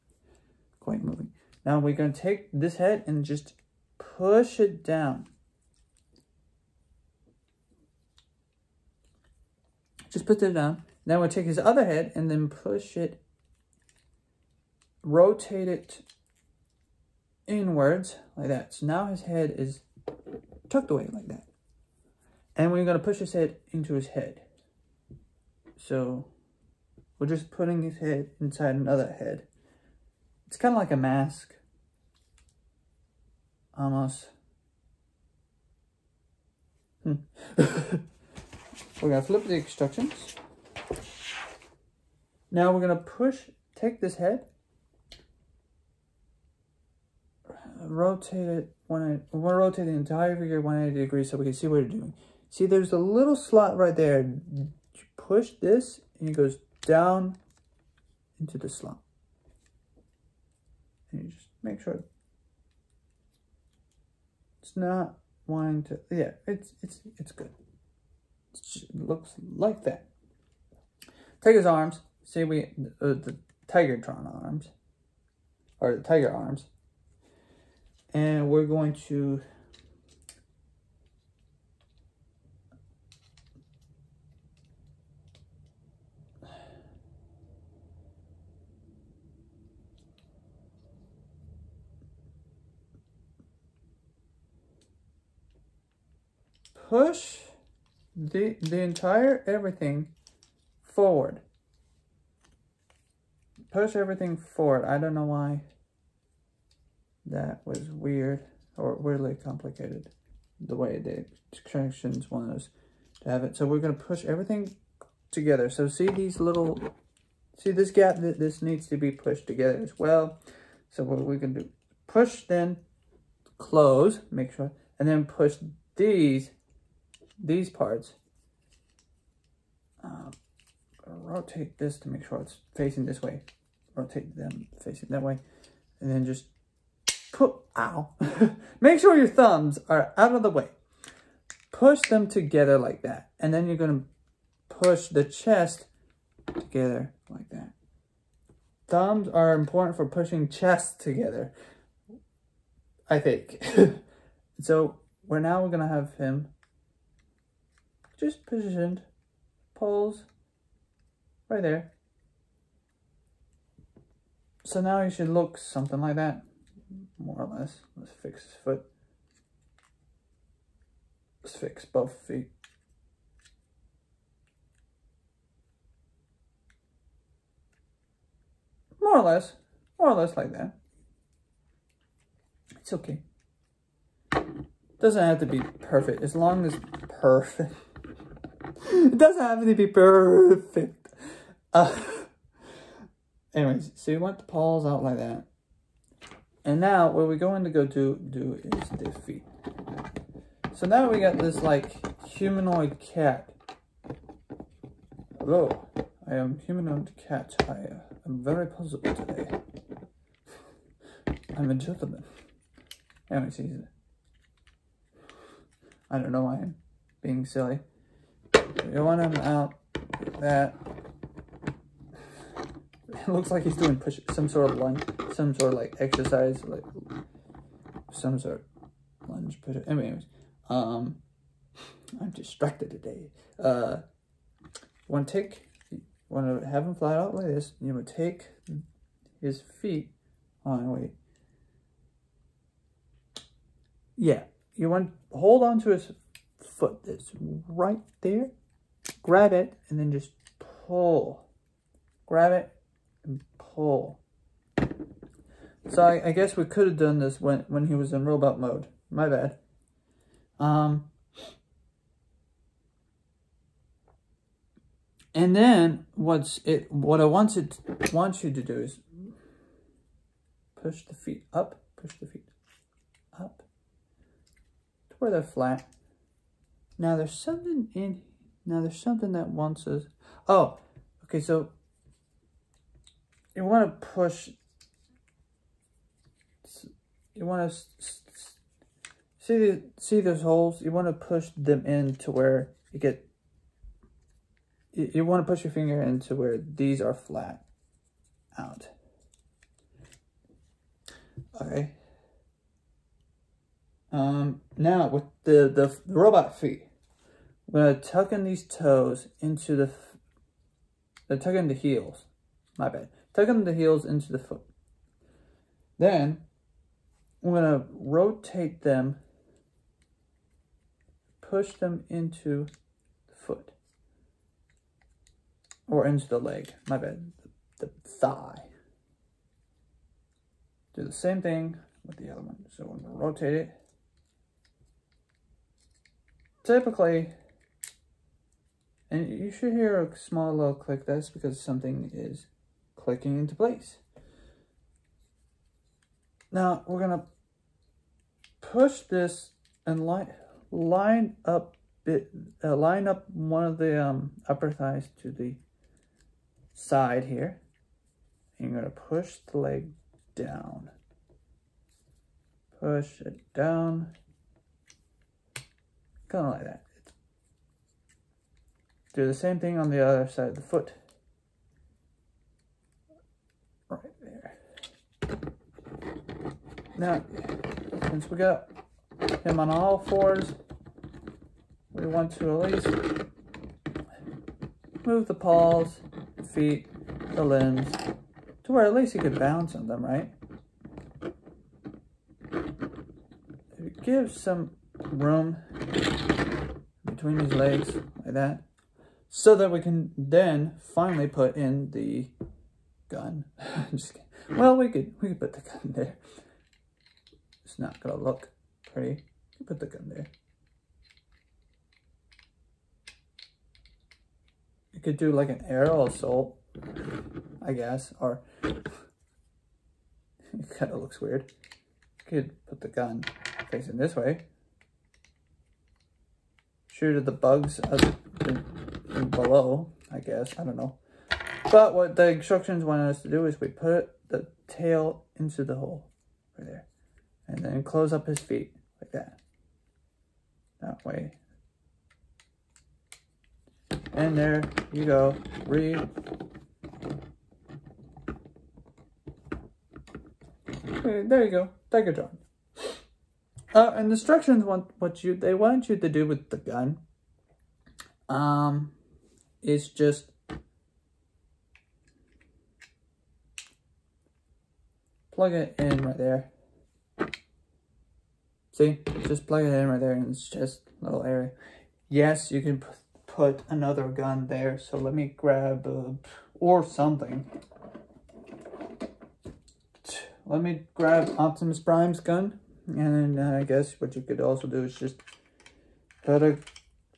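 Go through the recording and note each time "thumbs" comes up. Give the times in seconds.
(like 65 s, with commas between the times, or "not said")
139 s, 148 s.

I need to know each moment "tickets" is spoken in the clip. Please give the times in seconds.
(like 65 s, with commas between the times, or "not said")
not said.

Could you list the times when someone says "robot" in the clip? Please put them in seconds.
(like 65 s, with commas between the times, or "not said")
258 s, 306 s.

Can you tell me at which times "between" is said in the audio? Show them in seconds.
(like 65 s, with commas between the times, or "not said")
397 s.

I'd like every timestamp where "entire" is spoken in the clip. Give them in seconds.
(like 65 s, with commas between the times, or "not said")
49 s, 98 s.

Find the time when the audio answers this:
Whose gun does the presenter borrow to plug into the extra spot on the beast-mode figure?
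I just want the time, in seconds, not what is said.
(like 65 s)
481 s.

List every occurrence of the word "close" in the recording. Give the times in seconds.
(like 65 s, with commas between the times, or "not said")
123 s, 437 s.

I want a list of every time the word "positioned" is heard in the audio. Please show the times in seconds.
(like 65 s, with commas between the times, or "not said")
158 s.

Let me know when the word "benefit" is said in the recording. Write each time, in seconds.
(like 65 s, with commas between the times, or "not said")
not said.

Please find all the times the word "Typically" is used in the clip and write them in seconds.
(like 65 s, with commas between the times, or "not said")
336 s.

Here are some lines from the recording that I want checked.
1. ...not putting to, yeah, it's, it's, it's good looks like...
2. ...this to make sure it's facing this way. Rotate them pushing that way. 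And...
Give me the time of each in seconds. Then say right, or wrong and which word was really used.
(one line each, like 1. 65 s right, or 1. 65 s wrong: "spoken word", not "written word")
1. 64 s wrong: "wanting", not "putting"
2. 131 s wrong: "facing", not "pushing".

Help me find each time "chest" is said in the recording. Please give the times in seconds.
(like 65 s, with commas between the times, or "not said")
145 s, 150 s.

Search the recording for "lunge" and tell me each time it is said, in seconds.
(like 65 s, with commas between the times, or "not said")
224 s, 229 s.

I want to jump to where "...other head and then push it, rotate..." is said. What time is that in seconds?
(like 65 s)
11 s.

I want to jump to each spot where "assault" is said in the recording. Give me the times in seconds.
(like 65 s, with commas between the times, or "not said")
416 s.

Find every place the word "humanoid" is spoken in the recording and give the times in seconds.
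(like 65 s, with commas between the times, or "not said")
202 s, 206 s.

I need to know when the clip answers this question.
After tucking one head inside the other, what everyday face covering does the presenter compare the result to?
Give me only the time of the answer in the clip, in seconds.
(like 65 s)
30 s.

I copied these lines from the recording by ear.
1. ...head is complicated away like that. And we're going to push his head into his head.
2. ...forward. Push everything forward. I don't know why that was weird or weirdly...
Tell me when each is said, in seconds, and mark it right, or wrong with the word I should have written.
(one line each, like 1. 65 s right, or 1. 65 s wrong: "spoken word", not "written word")
1. 19 s wrong: "tucked", not "complicated"
2. 100 s right.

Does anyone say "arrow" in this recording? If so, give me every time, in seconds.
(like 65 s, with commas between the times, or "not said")
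415 s.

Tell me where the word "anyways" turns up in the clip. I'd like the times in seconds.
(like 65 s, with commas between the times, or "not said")
193 s, 213 s, 229 s.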